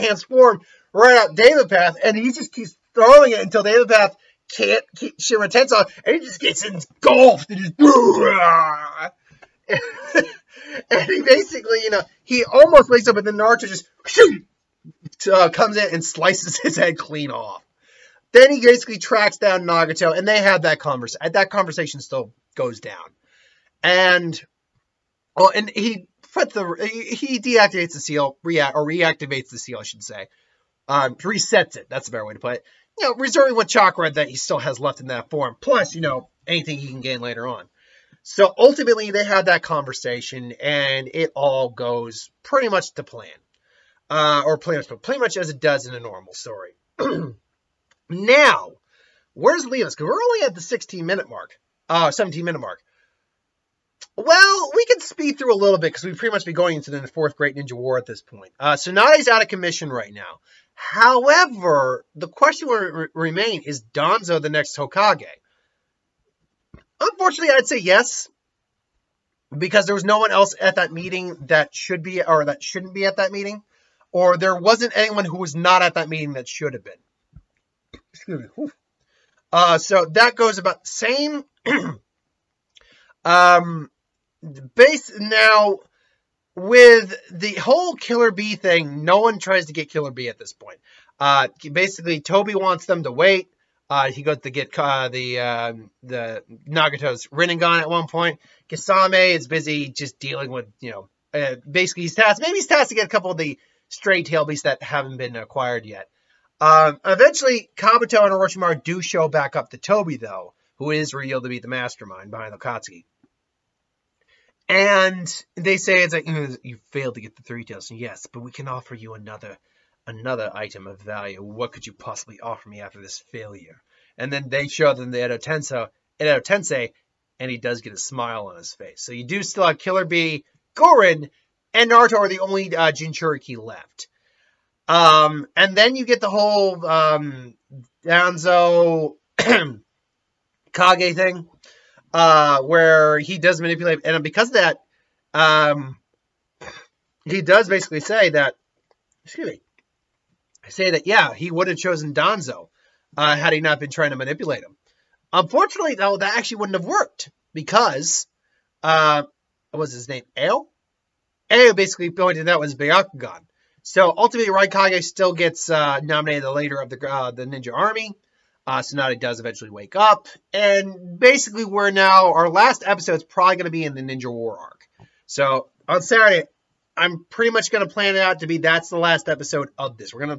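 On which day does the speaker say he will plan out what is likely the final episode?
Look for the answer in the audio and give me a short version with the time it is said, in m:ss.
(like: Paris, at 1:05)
Saturday, at 2:56.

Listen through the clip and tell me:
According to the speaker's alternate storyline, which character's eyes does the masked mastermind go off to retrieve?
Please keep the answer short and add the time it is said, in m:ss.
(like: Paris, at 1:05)
Nagato's Rinnegan, at 1:36.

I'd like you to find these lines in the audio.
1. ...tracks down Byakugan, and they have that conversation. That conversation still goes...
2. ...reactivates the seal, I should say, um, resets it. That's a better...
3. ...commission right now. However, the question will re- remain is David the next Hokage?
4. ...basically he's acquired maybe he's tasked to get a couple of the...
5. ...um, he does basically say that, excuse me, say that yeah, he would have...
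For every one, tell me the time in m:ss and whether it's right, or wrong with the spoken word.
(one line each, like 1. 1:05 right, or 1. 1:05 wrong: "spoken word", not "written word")
1. 0:18 wrong: "Nagato", not "Byakugan"
2. 0:28 right
3. 0:59 wrong: "Donzo", not "David"
4. 1:41 wrong: "tasked", not "acquired"
5. 2:25 right.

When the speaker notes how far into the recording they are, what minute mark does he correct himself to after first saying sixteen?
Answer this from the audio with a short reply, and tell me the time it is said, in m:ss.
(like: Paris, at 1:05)
17 minute mark, at 0:52.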